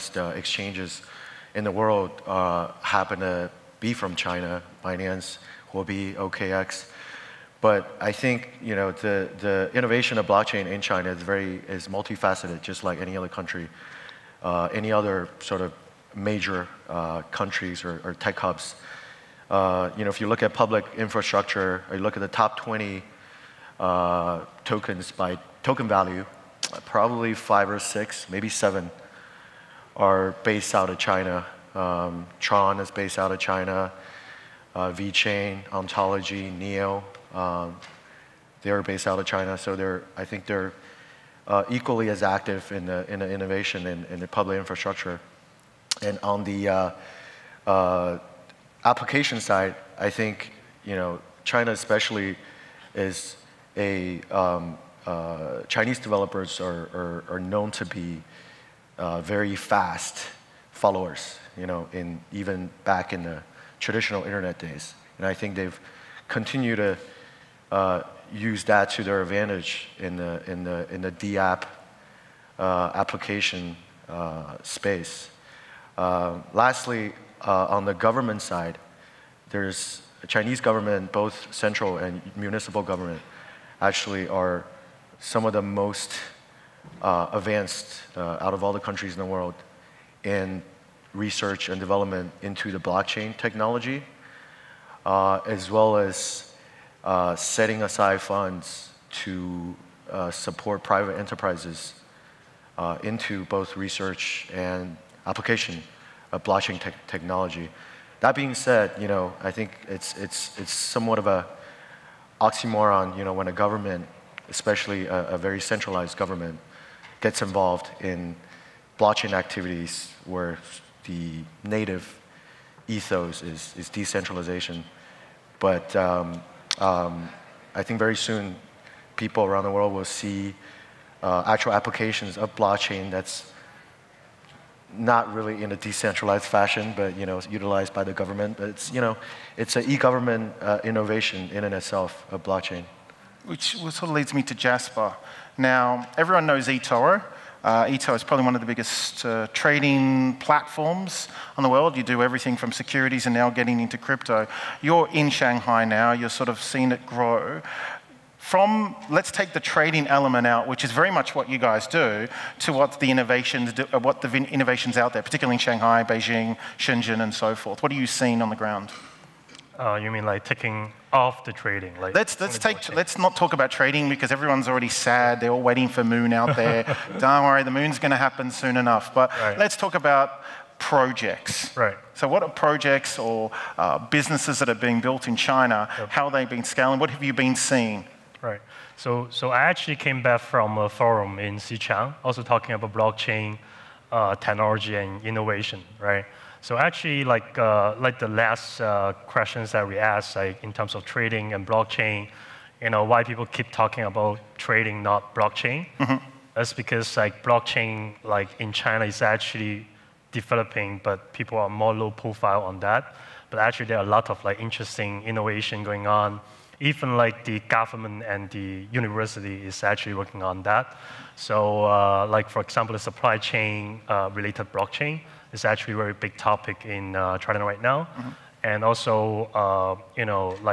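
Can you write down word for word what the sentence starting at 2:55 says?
They're all waiting for moon out there.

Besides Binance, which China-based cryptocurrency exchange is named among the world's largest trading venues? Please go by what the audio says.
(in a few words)
OKEx.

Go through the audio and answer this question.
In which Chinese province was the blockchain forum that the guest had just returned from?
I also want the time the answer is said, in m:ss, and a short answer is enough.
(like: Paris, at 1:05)
Sichuan, at 3:11.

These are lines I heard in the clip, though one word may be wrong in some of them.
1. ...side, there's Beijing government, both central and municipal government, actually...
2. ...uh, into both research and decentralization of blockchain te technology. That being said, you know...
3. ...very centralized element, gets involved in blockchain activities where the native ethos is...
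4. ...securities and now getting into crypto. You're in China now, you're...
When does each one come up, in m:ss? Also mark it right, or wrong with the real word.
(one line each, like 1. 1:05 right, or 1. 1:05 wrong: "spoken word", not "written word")
1. 1:18 wrong: "Chinese", not "Beijing"
2. 1:42 wrong: "application", not "decentralization"
3. 1:55 wrong: "government", not "element"
4. 2:32 wrong: "Shanghai", not "China".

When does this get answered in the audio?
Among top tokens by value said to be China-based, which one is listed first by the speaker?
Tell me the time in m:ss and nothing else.
0:32.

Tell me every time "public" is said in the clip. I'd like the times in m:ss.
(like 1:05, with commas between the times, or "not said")
0:20, 0:44.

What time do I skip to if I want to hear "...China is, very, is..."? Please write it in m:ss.
0:10.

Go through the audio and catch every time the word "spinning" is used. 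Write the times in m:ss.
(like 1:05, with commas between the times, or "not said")
not said.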